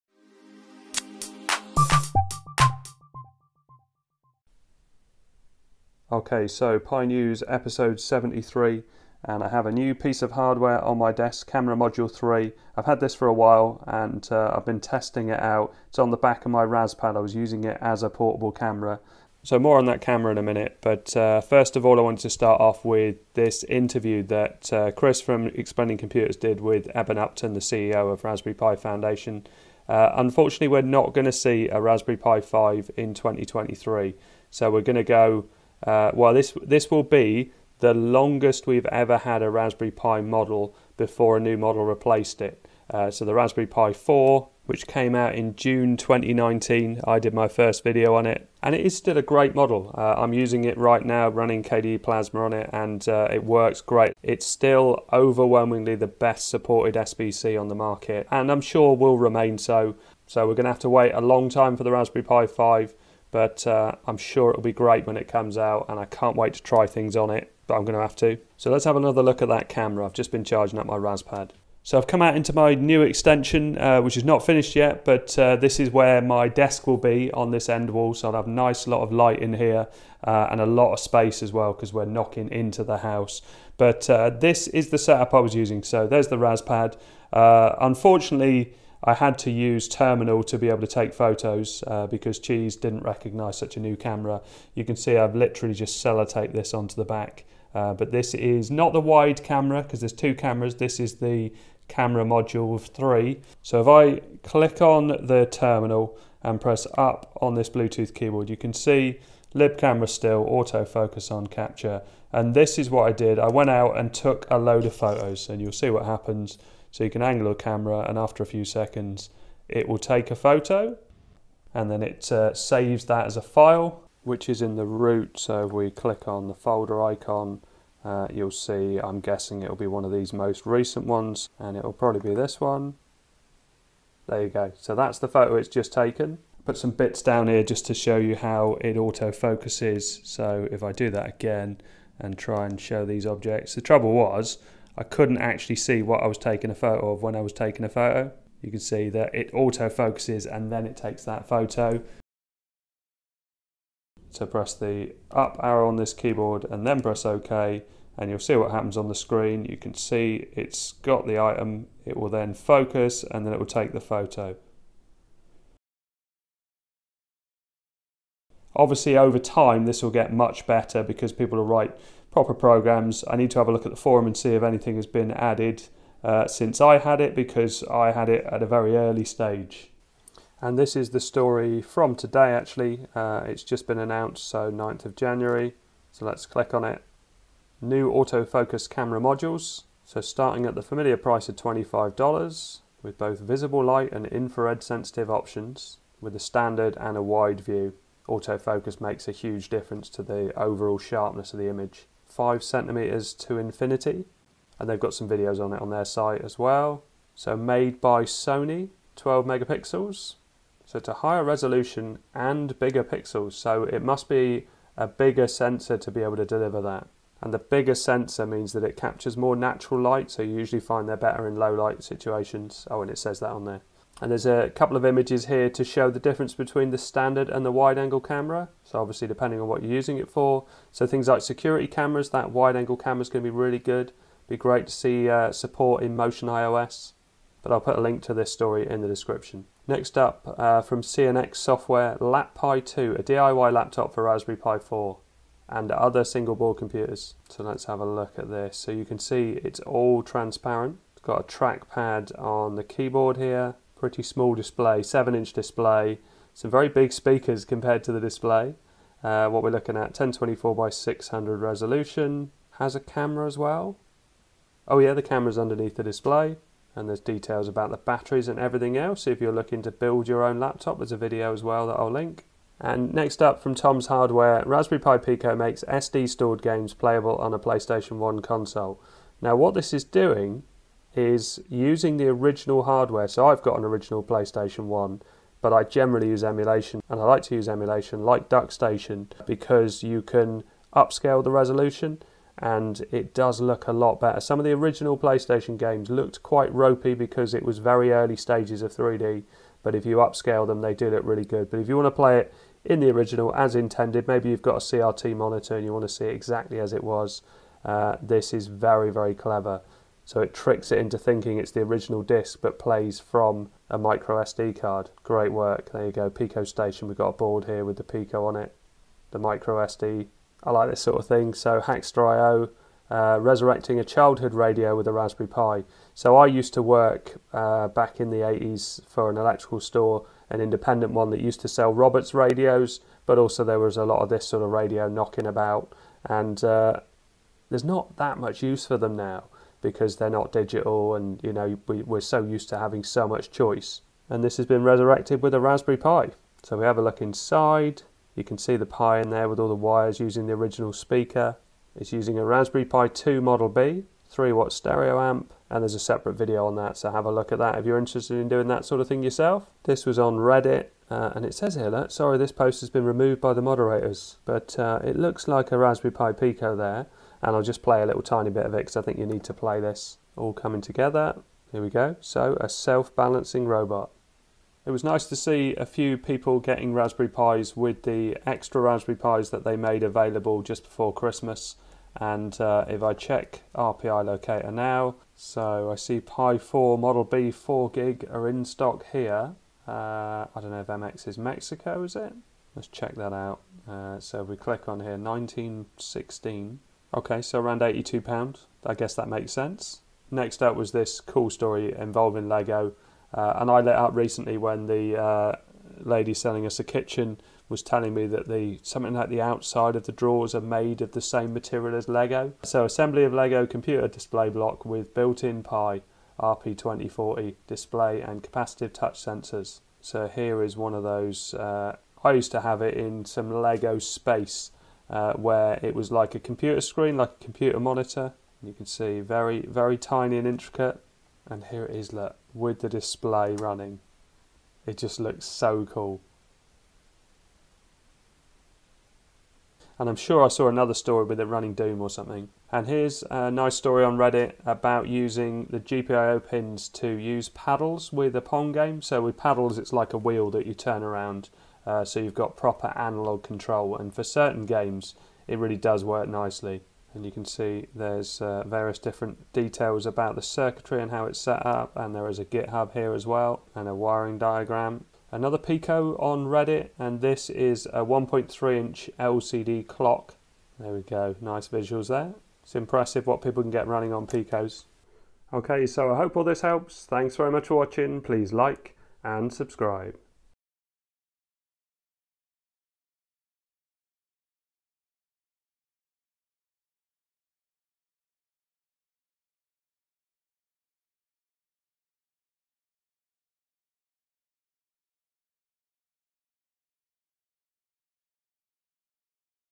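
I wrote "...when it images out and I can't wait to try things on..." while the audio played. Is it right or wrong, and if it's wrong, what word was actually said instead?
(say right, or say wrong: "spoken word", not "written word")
wrong: "comes", not "images".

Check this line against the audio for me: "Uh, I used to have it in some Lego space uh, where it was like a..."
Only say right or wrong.
right.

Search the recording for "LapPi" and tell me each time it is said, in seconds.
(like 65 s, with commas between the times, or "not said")
242 s.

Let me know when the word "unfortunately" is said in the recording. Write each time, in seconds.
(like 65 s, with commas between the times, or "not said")
30 s, 87 s.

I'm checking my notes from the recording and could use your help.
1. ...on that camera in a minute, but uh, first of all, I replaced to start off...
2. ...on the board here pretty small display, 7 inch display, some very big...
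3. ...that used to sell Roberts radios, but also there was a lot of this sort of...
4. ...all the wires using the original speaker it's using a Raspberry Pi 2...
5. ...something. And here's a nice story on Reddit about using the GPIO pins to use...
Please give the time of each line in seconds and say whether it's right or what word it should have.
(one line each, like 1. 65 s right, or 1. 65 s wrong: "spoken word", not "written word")
1. 19 s wrong: "wanted", not "replaced"
2. 252 s wrong: "keyboard", not "board"
3. 331 s right
4. 349 s right
5. 442 s right.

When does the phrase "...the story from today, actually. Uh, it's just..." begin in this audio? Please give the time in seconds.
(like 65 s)
181 s.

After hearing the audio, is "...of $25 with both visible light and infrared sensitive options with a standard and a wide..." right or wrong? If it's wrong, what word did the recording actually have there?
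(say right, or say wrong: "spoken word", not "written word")
right.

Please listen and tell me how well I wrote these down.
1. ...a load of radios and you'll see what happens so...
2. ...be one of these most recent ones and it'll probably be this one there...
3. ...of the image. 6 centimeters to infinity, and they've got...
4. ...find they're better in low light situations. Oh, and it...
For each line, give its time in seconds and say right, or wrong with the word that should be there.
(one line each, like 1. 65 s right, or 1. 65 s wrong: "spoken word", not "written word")
1. 114 s wrong: "photos", not "radios"
2. 129 s right
3. 201 s wrong: "5", not "6"
4. 220 s right.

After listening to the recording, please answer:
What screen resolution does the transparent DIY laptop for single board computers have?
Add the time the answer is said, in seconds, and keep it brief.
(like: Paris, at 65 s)
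1024 by 600, at 260 s.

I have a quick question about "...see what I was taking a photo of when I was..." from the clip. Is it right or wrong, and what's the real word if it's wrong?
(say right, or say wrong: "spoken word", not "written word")
right.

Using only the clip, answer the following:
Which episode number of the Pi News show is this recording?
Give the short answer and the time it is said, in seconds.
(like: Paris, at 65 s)
73, at 7 s.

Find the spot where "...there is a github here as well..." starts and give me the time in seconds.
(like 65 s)
462 s.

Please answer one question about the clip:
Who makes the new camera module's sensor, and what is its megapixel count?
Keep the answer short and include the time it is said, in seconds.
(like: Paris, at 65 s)
Sony, 12 megapixels, at 208 s.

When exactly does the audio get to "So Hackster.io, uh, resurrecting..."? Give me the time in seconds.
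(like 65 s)
321 s.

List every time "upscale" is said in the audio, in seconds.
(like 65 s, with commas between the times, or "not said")
290 s, 300 s.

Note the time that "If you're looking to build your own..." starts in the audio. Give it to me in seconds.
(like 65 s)
269 s.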